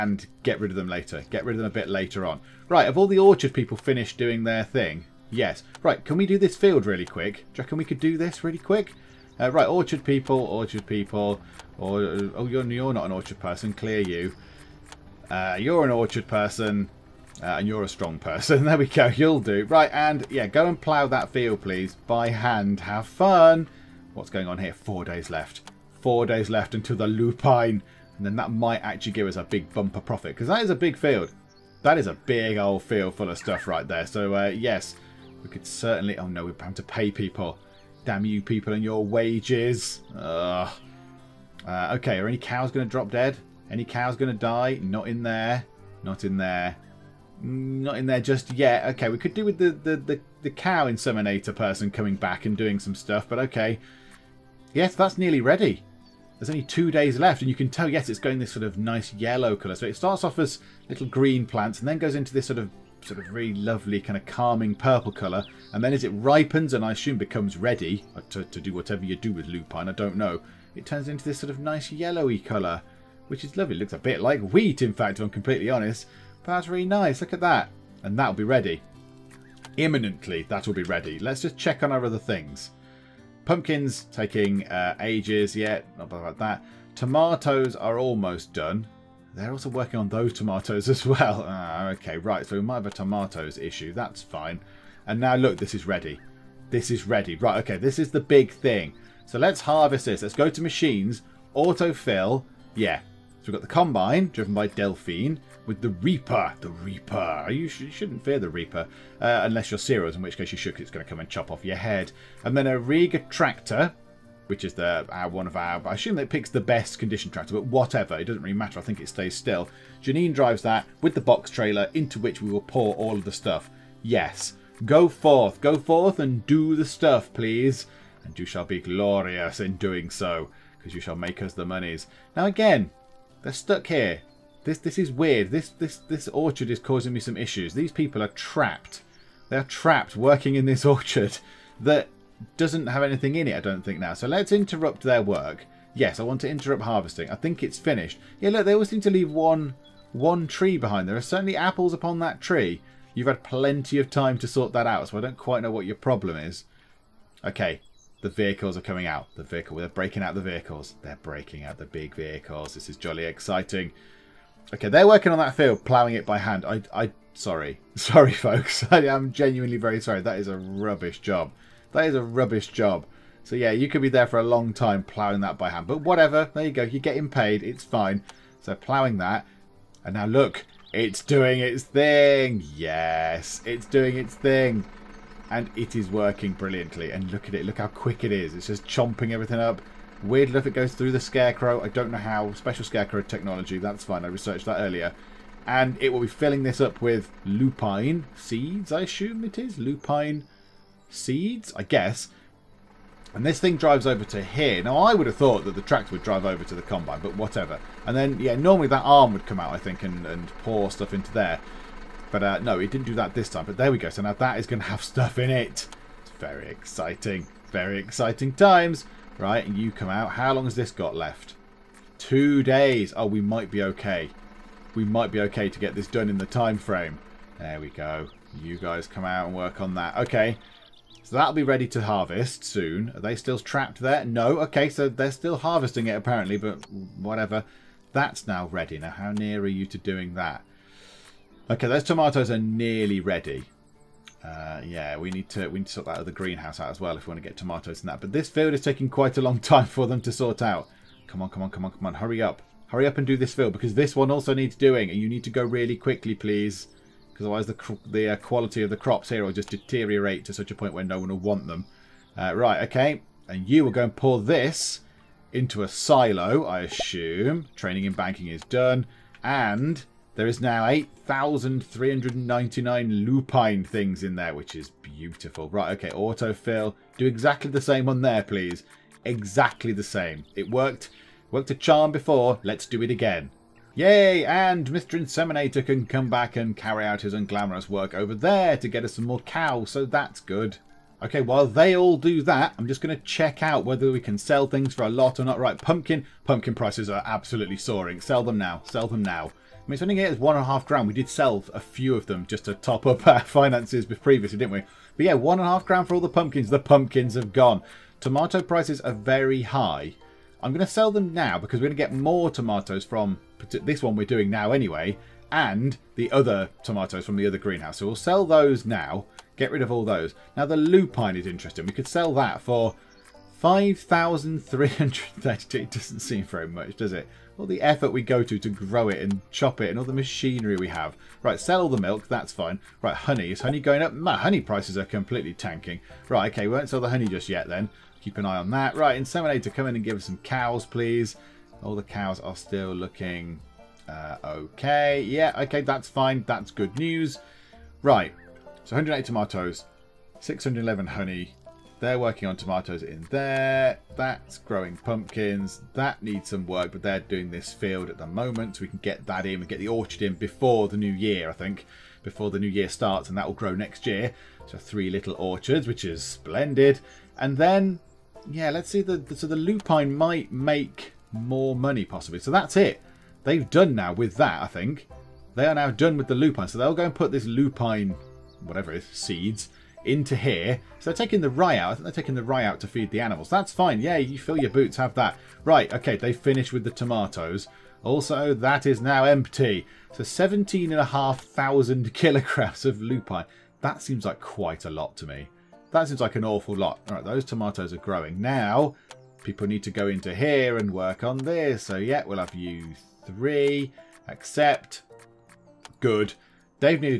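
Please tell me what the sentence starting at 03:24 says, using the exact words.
Now, I would have thought that the tractor would drive over to the combine, but whatever.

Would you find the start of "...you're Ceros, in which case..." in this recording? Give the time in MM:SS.
01:49.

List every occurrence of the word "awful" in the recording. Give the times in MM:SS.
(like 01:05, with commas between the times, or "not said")
06:36.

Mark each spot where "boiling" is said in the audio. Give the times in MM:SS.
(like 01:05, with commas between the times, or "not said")
not said.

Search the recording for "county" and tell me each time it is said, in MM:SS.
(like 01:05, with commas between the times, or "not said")
not said.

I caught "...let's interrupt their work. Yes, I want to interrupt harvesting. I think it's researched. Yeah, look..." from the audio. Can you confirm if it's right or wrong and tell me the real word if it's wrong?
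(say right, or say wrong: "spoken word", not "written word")
wrong: "finished", not "researched".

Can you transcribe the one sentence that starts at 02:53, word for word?
So yeah, you could be there for a long time ploughing that by hand.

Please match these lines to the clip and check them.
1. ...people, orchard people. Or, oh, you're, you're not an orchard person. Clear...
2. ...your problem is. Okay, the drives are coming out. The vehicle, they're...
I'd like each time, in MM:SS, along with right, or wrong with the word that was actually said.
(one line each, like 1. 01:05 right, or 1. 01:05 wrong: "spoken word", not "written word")
1. 00:10 right
2. 02:35 wrong: "vehicles", not "drives".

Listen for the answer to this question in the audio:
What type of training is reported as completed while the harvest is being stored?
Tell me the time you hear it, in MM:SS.
04:27.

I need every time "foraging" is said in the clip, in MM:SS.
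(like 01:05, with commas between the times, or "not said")
not said.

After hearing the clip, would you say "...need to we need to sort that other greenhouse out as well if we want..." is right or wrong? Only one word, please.
right.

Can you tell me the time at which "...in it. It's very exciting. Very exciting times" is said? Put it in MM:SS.
03:35.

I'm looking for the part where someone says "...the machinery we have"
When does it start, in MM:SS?
05:30.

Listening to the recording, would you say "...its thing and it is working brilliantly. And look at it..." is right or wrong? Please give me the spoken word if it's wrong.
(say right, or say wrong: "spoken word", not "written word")
right.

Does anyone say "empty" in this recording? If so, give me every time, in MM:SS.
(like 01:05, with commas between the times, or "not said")
06:29.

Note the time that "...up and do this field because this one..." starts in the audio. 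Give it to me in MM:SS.
04:13.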